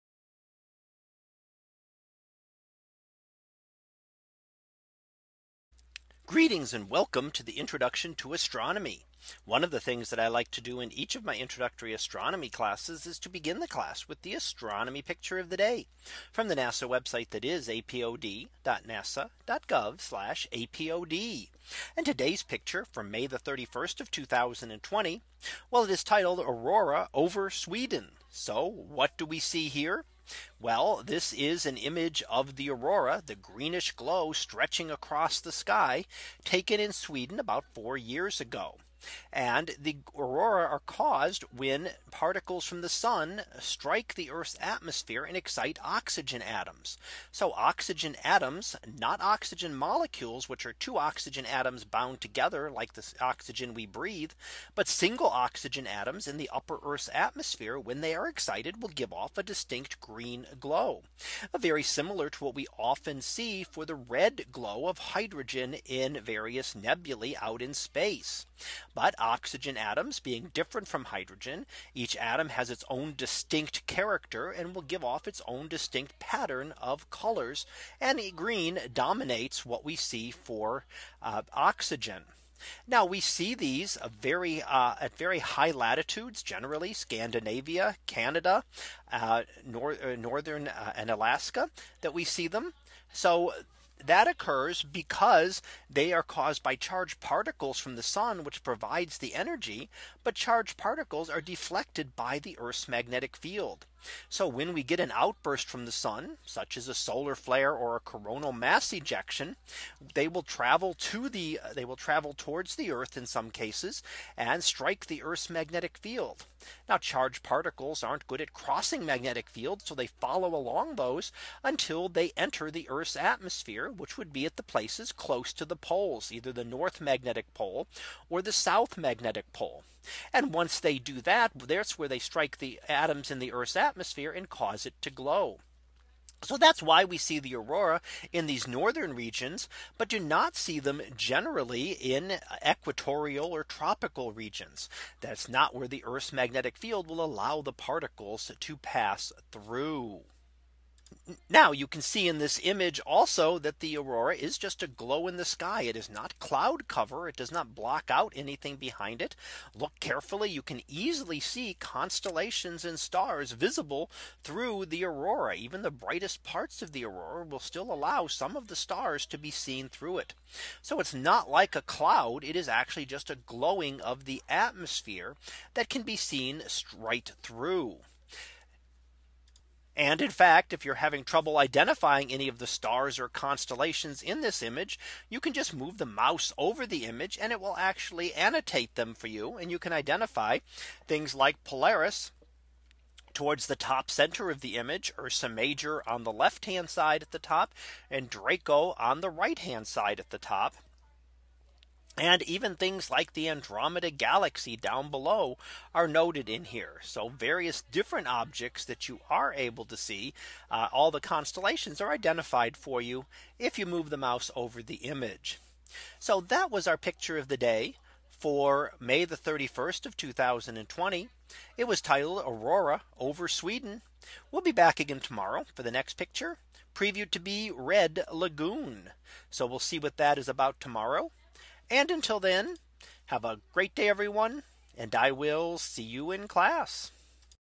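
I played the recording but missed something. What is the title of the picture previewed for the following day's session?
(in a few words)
Red Lagoon.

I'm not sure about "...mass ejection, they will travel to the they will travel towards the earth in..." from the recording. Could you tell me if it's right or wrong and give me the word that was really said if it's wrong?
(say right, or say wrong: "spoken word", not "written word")
right.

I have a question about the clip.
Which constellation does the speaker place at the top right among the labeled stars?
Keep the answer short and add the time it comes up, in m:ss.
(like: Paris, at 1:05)
Draco, at 3:18.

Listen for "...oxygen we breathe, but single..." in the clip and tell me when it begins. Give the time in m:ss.
0:53.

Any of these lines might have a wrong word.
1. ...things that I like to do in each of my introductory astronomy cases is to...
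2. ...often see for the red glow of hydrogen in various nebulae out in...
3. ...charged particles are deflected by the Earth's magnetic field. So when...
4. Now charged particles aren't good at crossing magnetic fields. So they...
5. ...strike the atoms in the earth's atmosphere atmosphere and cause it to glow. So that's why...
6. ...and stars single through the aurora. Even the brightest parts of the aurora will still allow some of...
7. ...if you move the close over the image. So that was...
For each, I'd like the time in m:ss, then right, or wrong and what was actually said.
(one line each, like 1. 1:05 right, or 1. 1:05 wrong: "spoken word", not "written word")
1. 0:09 wrong: "classes", not "cases"
2. 1:02 right
3. 1:40 right
4. 1:56 right
5. 2:12 right
6. 2:42 wrong: "visible", not "single"
7. 3:33 wrong: "mouse", not "close".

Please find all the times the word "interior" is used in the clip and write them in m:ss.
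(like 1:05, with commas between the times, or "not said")
not said.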